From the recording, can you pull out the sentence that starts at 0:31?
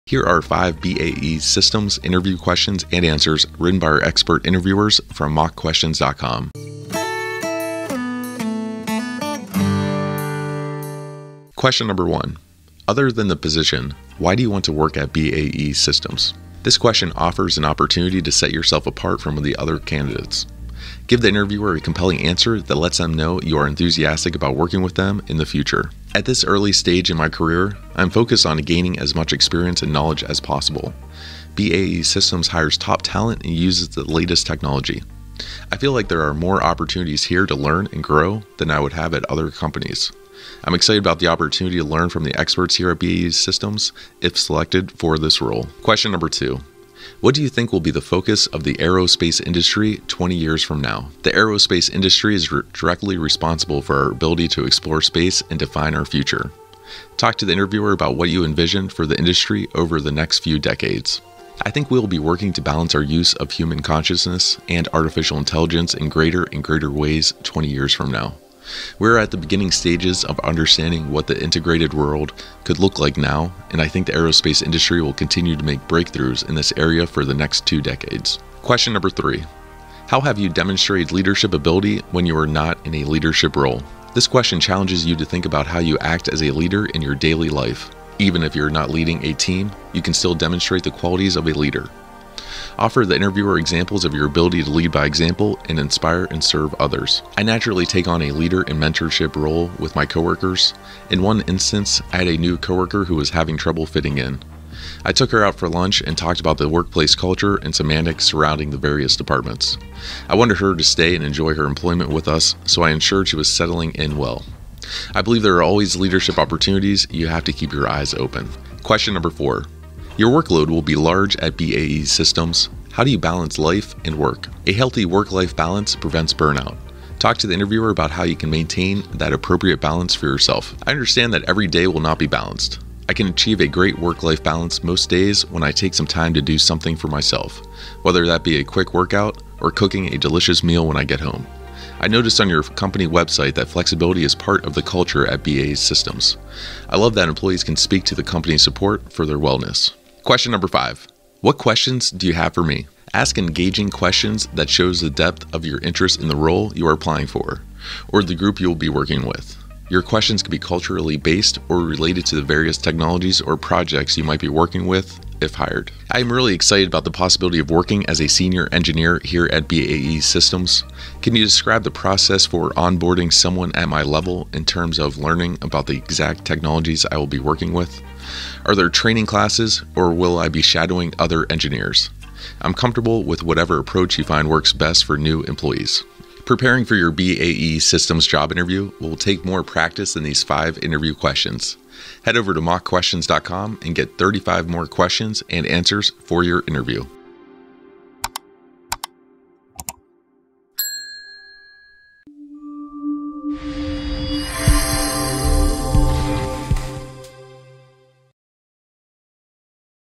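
BAE Systems hires top talent and uses the latest technology.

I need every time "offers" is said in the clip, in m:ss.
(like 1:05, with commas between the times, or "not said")
0:17, 1:32.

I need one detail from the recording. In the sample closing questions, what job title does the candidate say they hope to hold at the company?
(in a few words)
senior engineer.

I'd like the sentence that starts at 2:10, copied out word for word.
I understand that every day will not be balanced.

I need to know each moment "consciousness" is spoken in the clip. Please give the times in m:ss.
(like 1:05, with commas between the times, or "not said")
1:03.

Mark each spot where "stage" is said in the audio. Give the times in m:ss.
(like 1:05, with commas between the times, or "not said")
0:26, 1:09.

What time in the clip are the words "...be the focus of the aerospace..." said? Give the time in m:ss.
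0:47.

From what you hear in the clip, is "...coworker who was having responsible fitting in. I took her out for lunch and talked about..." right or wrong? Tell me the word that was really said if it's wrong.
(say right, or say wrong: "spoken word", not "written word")
wrong: "trouble", not "responsible".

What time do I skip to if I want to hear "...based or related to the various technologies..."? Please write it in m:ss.
2:41.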